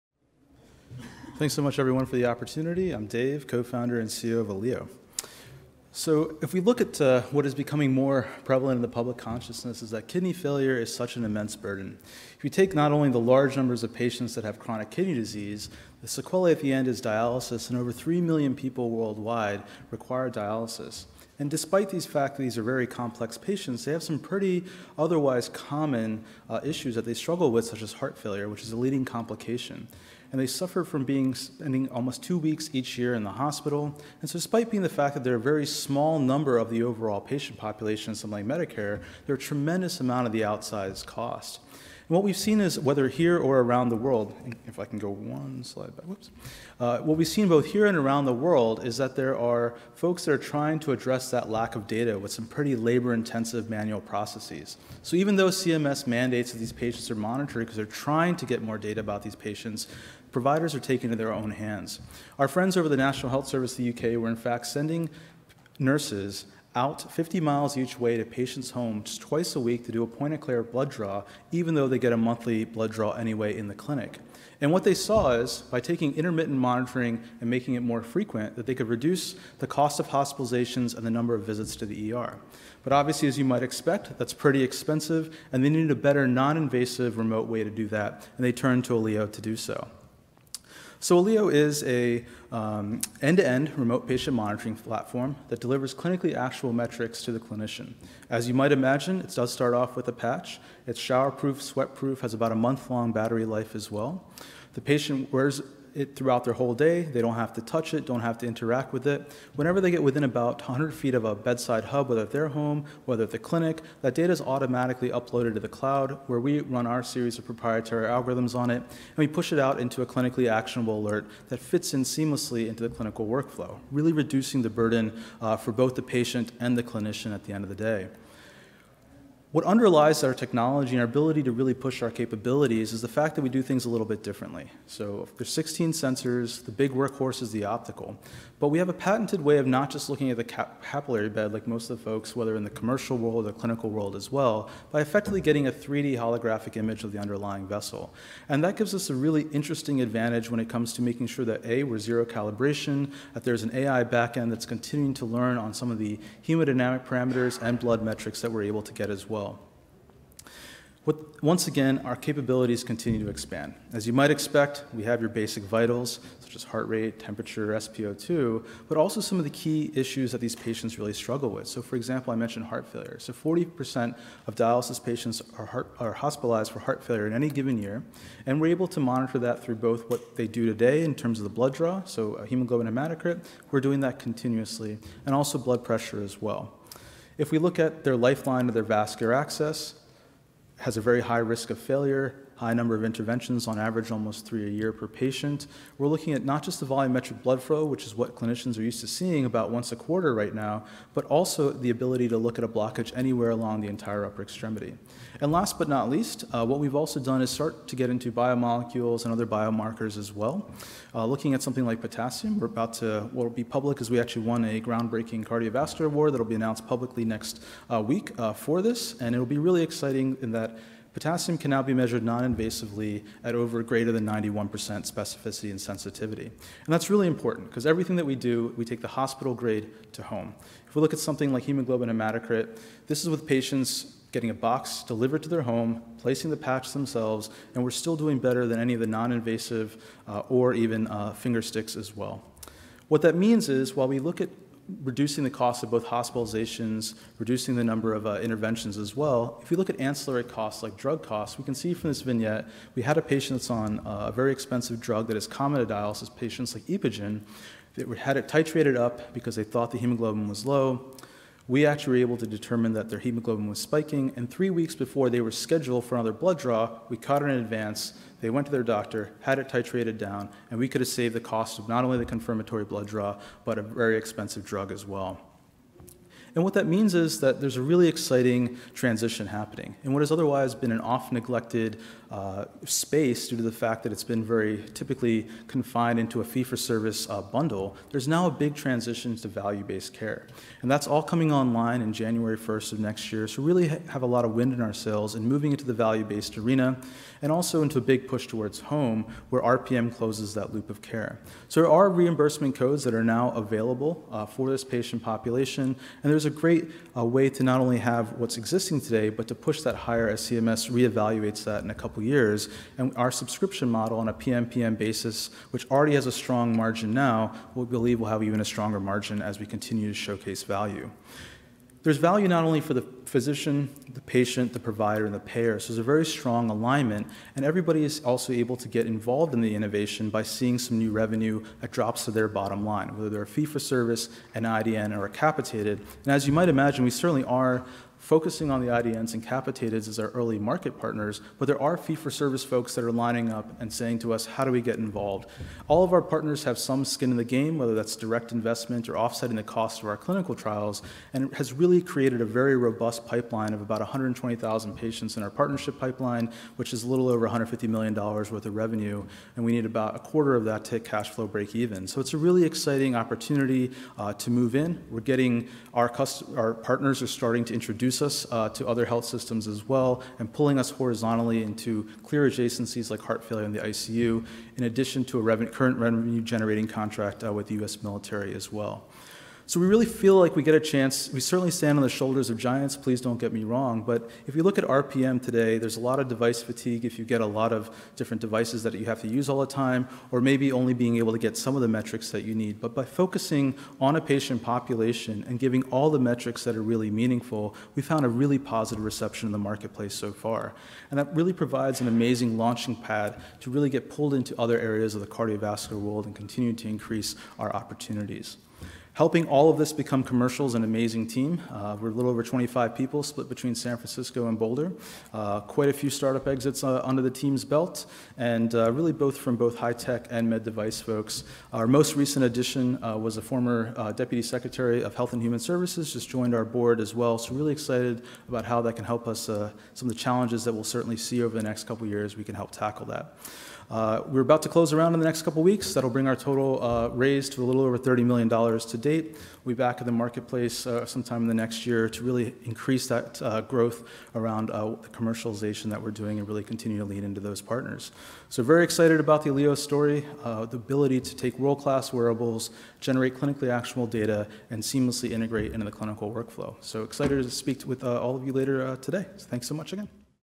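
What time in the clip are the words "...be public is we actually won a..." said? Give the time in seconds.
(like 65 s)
213 s.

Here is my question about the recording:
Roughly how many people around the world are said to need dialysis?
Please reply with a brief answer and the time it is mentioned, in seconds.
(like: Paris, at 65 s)
over 3 million, at 17 s.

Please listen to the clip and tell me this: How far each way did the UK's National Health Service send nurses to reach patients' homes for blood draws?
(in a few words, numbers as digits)
50 miles.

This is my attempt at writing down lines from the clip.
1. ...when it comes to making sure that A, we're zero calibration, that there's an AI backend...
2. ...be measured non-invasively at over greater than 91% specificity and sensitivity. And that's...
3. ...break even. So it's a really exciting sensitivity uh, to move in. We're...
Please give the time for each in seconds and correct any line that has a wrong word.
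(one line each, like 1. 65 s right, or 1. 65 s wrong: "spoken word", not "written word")
1. 150 s right
2. 221 s right
3. 361 s wrong: "opportunity", not "sensitivity".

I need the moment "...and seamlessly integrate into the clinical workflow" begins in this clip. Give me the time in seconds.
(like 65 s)
454 s.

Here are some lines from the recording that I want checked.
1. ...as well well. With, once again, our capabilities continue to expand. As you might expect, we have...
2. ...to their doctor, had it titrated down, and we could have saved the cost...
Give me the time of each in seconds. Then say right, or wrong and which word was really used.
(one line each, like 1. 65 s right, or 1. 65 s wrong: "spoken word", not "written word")
1. 159 s right
2. 268 s right.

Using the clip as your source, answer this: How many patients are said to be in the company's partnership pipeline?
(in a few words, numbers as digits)
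120,000.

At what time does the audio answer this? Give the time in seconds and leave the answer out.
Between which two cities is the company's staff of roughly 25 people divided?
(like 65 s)
413 s.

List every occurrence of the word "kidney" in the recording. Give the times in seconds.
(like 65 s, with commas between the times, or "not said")
10 s, 14 s.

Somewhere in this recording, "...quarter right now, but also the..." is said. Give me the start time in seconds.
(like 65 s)
199 s.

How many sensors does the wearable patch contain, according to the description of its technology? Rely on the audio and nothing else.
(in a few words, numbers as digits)
16.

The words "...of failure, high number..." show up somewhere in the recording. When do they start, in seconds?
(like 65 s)
191 s.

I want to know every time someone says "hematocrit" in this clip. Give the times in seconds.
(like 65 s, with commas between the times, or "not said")
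182 s, 232 s.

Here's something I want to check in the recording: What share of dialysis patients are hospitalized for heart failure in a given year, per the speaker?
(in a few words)
40%.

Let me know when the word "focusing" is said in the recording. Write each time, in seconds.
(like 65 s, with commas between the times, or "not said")
338 s, 393 s.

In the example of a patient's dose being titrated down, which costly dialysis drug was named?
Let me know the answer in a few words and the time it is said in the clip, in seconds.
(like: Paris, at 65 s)
Epogen, at 256 s.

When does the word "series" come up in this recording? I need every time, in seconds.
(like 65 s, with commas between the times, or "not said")
117 s.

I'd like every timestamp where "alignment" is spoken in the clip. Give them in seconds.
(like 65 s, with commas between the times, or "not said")
326 s.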